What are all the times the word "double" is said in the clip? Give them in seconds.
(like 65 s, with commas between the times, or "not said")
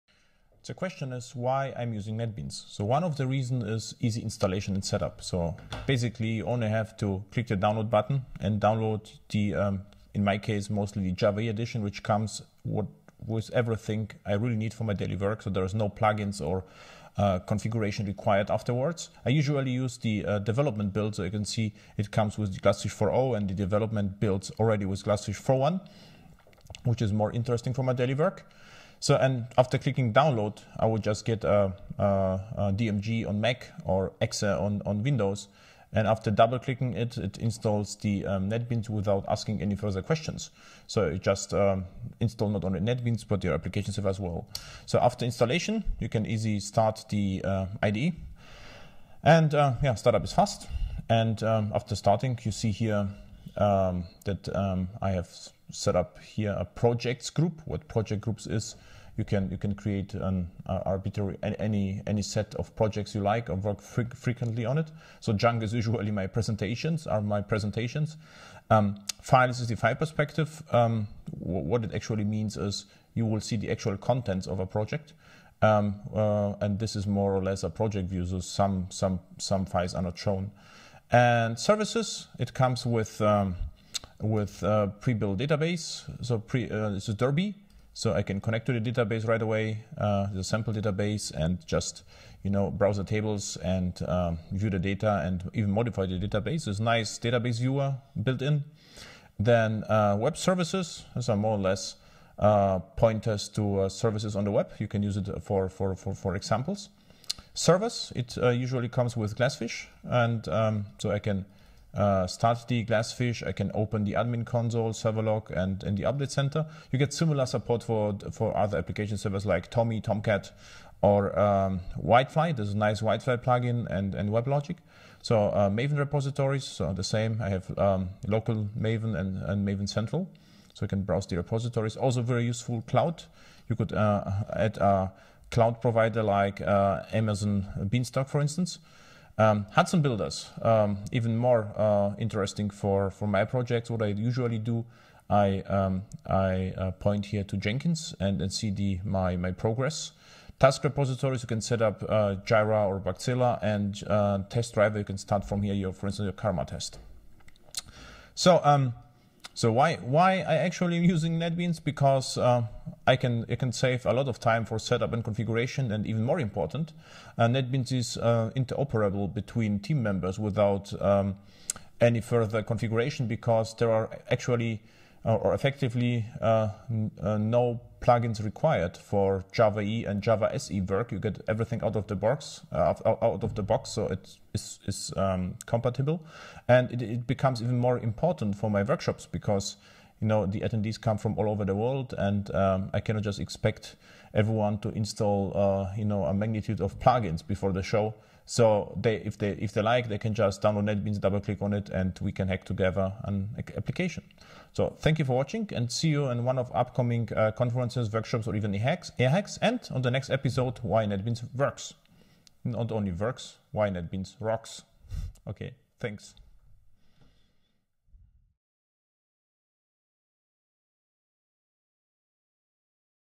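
36 s, 201 s.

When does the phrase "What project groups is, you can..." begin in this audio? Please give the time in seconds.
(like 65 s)
57 s.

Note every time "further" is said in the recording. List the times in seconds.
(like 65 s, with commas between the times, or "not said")
39 s, 172 s.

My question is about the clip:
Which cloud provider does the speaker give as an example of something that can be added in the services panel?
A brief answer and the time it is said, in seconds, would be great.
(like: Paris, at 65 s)
Amazon Beanstalk, at 137 s.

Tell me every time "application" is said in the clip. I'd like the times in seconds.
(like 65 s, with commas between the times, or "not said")
43 s, 118 s, 203 s.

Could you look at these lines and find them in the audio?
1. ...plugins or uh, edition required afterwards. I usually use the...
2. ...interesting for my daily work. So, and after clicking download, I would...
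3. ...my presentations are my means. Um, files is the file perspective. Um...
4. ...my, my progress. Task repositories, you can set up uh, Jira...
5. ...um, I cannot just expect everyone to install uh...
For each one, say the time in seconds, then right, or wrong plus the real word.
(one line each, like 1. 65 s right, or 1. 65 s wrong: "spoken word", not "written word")
1. 15 s wrong: "configuration", not "edition"
2. 27 s right
3. 66 s wrong: "presentations", not "means"
4. 149 s right
5. 192 s right.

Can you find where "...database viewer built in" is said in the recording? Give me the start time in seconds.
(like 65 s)
97 s.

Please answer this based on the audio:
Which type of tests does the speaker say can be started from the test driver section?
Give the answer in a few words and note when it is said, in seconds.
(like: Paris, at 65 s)
Karma, at 156 s.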